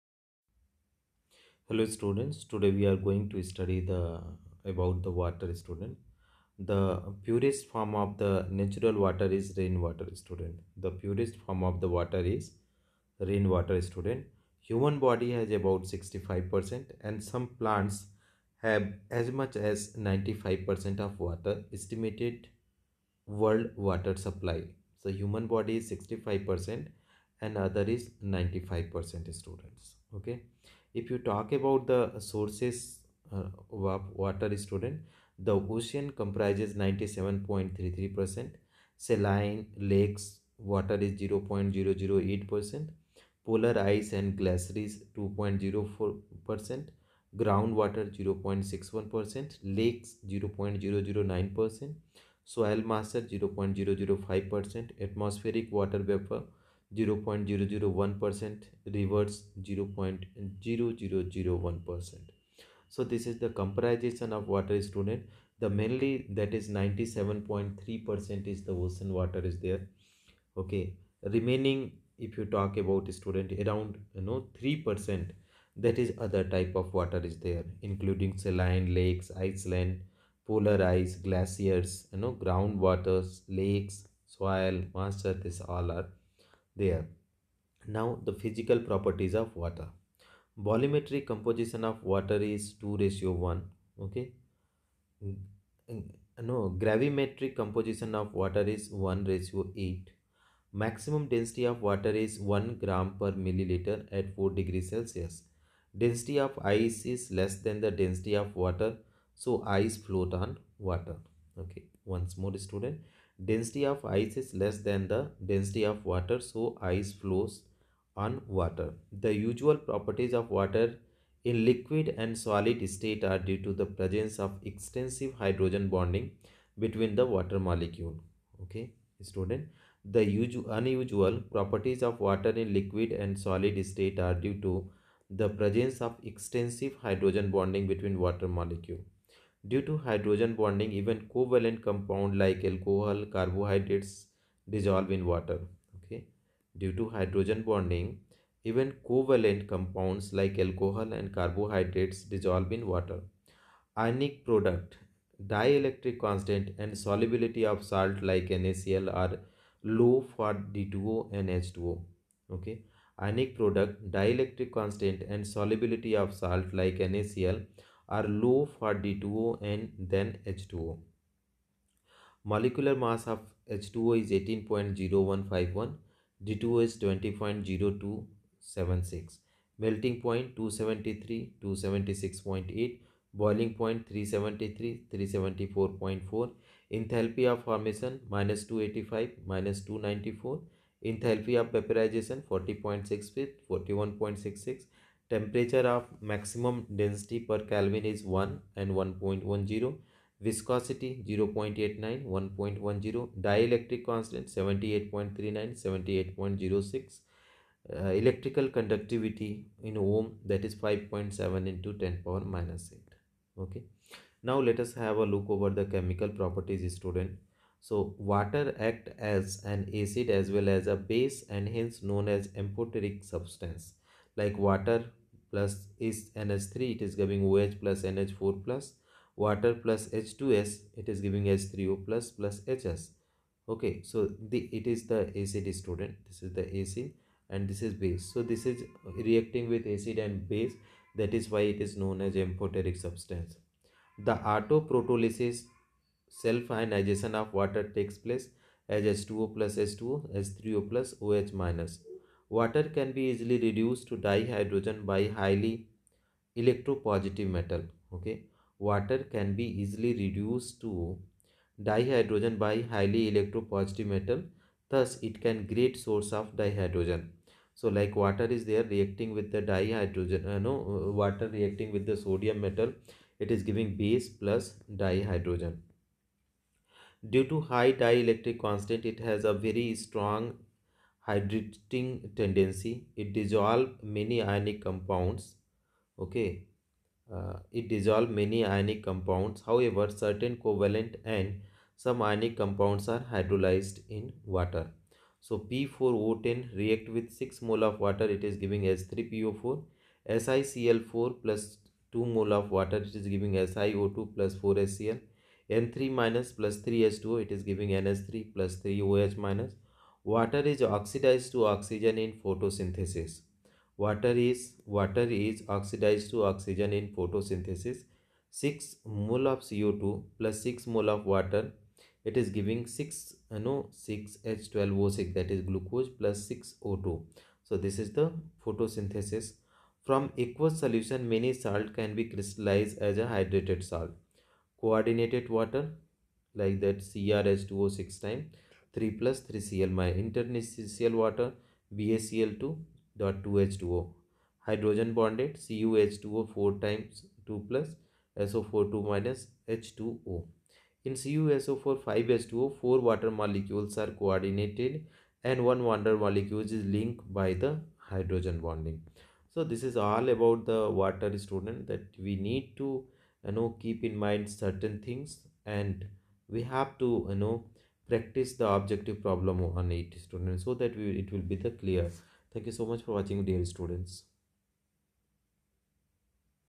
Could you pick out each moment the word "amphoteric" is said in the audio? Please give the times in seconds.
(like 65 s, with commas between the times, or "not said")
222 s, 242 s.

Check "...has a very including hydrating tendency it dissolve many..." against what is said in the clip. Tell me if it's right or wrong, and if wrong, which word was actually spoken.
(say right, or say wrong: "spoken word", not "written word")
wrong: "strong", not "including".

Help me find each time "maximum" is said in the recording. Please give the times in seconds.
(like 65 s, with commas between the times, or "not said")
100 s, 196 s.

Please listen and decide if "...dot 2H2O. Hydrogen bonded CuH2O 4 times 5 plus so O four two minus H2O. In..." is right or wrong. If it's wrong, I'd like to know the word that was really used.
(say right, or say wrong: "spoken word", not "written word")
wrong: "2", not "5".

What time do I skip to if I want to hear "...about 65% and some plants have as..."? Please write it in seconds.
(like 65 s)
15 s.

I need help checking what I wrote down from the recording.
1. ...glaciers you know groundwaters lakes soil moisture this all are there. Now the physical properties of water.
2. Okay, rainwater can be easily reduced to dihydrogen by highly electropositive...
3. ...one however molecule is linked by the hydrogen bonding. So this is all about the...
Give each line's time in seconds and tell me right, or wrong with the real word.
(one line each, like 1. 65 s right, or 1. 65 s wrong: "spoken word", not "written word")
1. 81 s right
2. 258 s wrong: "water", not "rainwater"
3. 355 s wrong: "water", not "however".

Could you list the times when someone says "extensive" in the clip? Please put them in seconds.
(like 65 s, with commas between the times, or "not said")
124 s, 136 s.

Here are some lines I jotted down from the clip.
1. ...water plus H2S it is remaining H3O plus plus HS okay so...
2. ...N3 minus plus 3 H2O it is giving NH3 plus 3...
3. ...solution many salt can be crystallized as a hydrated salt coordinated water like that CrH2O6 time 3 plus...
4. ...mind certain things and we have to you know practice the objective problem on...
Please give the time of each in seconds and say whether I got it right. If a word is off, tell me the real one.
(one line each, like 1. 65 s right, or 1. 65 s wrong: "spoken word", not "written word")
1. 229 s wrong: "giving", not "remaining"
2. 305 s right
3. 330 s right
4. 364 s right.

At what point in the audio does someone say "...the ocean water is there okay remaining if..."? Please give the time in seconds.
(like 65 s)
68 s.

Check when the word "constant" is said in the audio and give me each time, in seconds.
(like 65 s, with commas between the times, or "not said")
156 s, 164 s, 204 s, 278 s.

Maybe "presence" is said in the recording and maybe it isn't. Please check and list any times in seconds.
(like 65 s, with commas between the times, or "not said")
123 s, 135 s.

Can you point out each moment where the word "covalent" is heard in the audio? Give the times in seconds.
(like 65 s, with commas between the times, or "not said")
141 s, 149 s, 290 s.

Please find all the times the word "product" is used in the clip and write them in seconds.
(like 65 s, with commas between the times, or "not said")
154 s, 163 s.